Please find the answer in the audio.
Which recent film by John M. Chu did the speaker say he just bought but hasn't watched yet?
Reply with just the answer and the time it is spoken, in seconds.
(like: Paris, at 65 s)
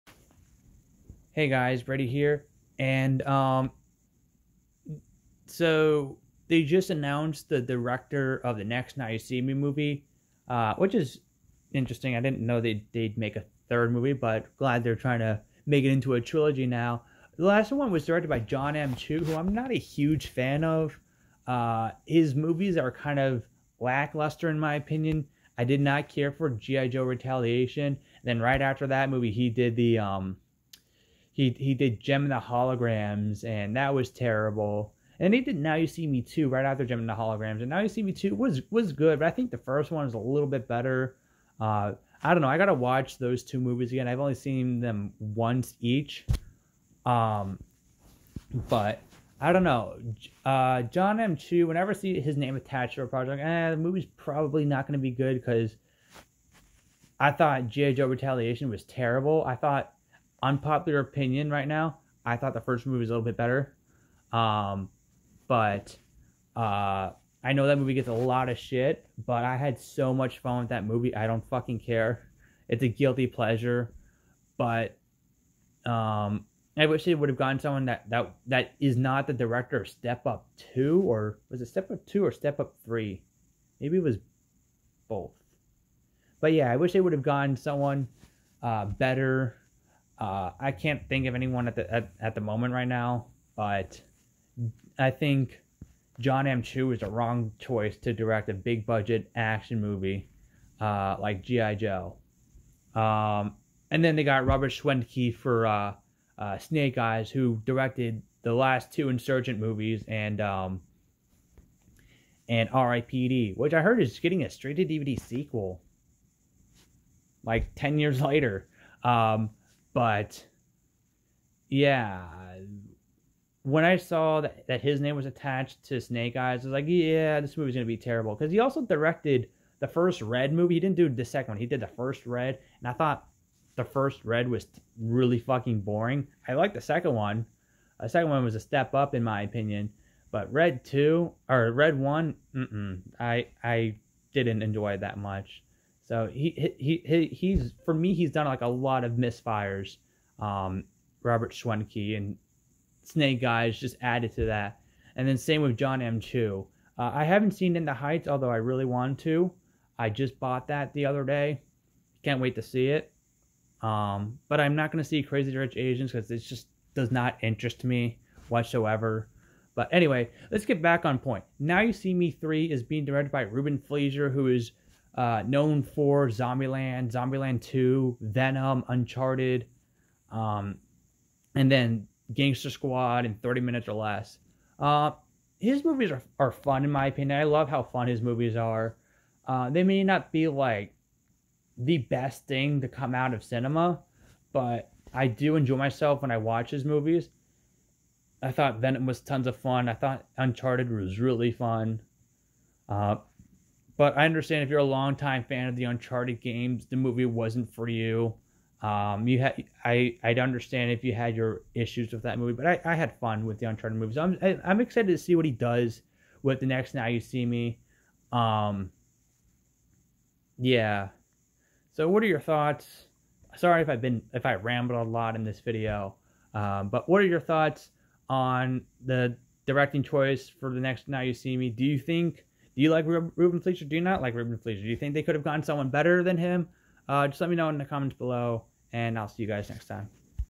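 In the Heights, at 157 s.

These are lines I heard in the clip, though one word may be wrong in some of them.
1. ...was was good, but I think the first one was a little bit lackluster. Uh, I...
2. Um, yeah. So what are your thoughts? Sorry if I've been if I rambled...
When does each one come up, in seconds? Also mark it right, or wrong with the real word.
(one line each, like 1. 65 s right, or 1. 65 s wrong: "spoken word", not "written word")
1. 38 s wrong: "better", not "lackluster"
2. 218 s right.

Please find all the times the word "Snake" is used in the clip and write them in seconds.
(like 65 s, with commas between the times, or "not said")
106 s, 126 s, 153 s.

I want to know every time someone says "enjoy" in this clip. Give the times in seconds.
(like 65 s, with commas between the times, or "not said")
144 s, 195 s.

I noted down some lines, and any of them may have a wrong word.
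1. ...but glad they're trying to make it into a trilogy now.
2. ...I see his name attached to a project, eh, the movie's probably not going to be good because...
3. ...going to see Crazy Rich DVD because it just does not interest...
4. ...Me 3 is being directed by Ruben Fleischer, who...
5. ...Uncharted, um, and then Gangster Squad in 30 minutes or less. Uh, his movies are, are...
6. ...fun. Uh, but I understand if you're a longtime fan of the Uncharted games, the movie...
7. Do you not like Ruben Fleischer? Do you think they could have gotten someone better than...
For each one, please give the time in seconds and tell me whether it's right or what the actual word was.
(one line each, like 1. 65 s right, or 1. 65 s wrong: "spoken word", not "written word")
1. 14 s right
2. 51 s right
3. 164 s wrong: "Asians", not "DVD"
4. 172 s right
5. 178 s right
6. 201 s right
7. 233 s right.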